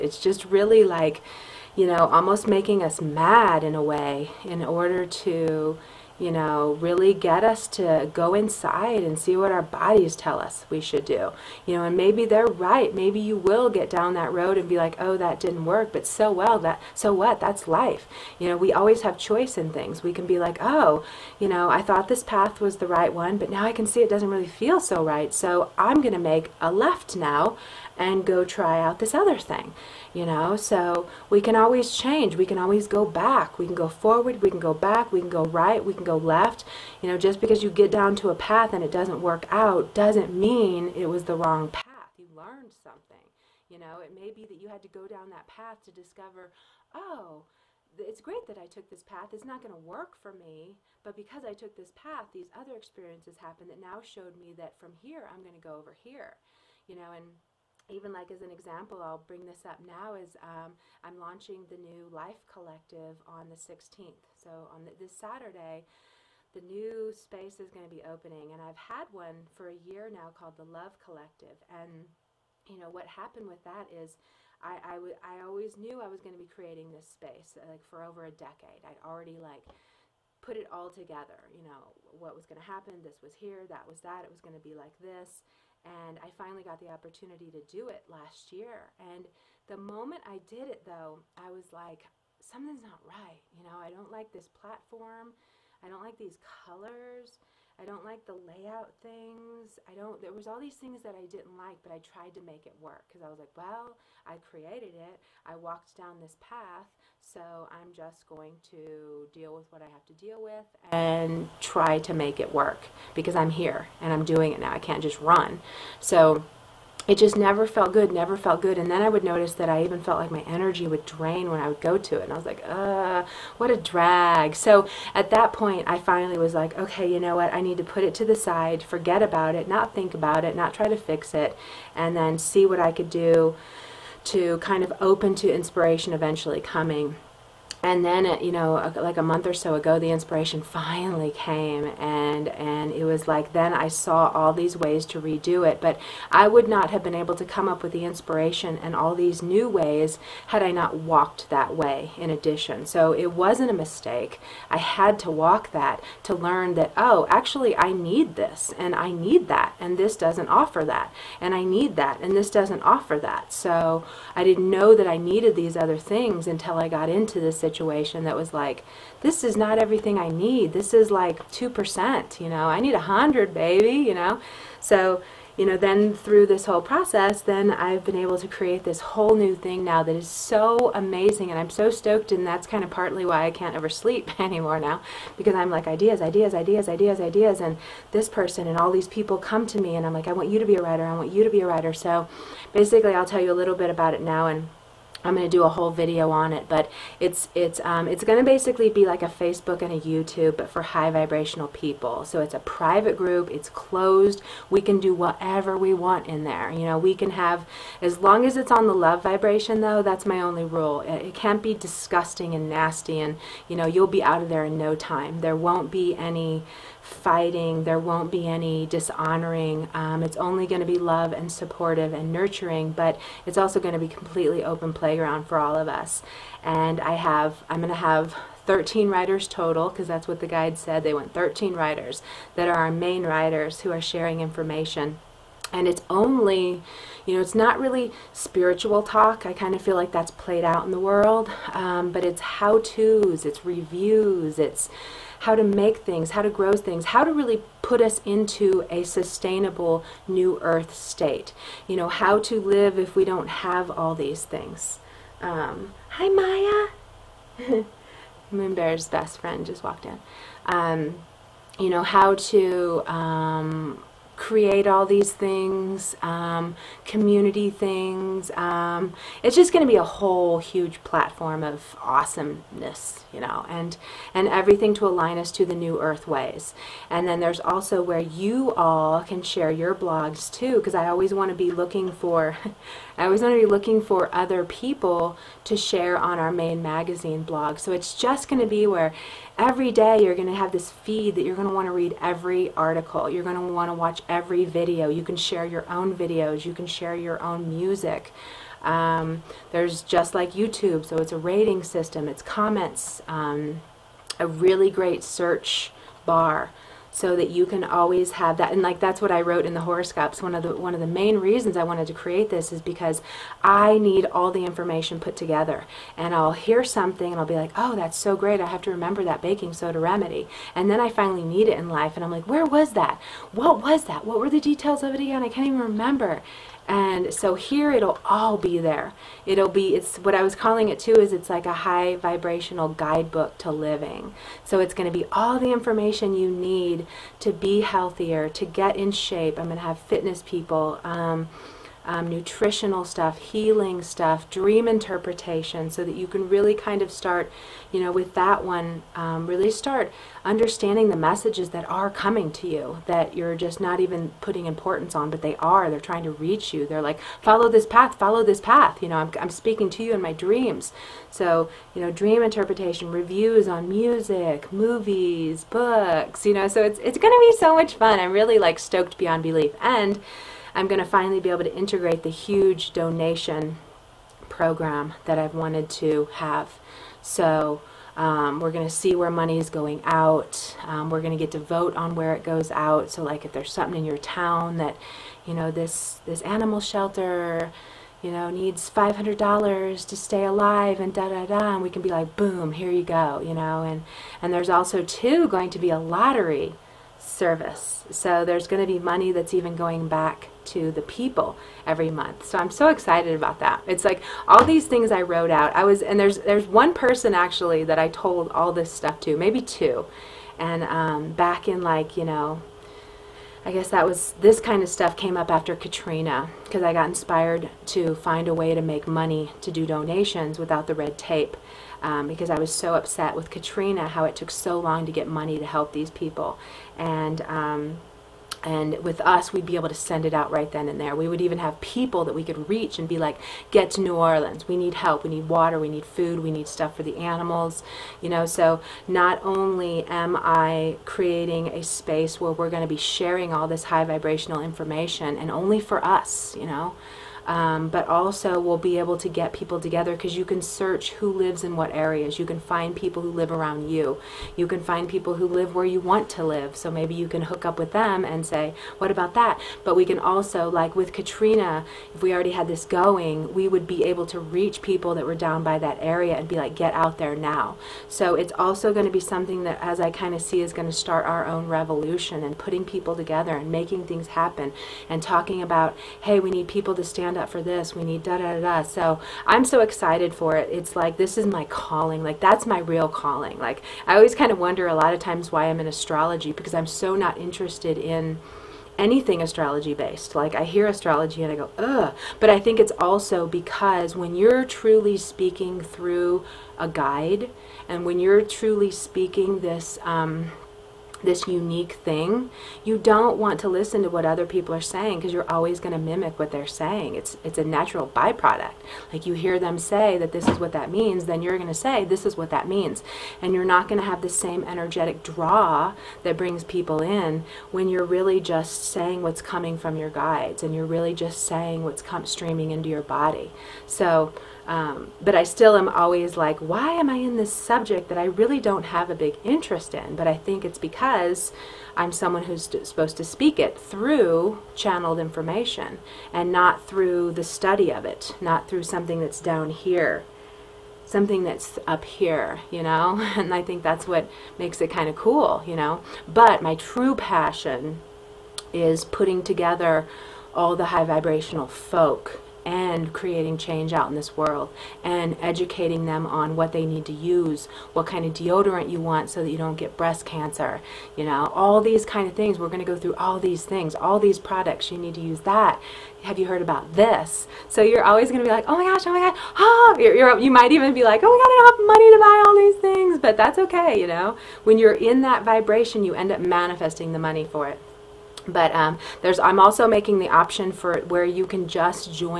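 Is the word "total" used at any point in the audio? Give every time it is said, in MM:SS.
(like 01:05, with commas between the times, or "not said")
03:49.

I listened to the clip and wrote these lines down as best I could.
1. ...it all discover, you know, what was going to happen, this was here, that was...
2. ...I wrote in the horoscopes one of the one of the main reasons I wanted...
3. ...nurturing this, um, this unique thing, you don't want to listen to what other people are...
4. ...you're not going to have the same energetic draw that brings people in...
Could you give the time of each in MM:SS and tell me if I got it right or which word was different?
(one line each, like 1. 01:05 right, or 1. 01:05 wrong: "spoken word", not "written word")
1. 01:20 wrong: "together", not "discover"
2. 05:09 right
3. 08:18 wrong: "speaking", not "nurturing"
4. 08:33 right.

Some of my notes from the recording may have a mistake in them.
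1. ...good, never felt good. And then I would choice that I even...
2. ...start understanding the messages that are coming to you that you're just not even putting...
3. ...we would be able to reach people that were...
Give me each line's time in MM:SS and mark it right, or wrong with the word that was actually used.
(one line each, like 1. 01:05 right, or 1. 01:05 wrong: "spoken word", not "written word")
1. 01:57 wrong: "notice", not "choice"
2. 05:49 right
3. 07:43 right.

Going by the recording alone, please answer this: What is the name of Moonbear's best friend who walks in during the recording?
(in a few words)
Maya.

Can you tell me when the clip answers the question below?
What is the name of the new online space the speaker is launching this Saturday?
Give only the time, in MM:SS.
01:02.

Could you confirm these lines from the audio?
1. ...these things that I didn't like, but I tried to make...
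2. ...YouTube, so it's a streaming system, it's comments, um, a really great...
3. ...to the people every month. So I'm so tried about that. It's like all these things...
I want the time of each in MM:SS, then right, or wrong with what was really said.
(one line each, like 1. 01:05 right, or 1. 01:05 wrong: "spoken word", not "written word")
1. 01:40 right
2. 05:00 wrong: "rating", not "streaming"
3. 06:40 wrong: "excited", not "tried".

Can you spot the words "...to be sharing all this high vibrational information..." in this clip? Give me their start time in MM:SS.
07:22.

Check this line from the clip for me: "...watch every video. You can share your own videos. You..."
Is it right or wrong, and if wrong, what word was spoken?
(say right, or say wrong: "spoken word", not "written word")
right.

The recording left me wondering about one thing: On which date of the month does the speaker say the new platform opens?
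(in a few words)
16th.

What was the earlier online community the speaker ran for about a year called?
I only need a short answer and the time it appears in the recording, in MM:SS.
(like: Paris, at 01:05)
Love Collective, at 01:10.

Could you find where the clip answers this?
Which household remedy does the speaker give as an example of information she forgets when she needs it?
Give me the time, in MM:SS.
05:19.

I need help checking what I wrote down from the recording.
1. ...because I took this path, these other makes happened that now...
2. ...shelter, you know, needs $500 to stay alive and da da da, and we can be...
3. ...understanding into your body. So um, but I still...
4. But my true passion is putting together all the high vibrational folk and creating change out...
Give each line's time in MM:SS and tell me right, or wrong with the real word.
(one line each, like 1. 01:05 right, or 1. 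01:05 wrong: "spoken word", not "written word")
1. 00:51 wrong: "experiences", not "makes"
2. 06:26 right
3. 08:42 wrong: "streaming", not "understanding"
4. 09:06 right.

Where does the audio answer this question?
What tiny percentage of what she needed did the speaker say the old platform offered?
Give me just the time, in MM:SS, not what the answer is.
02:51.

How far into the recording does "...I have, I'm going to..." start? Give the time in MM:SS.
03:46.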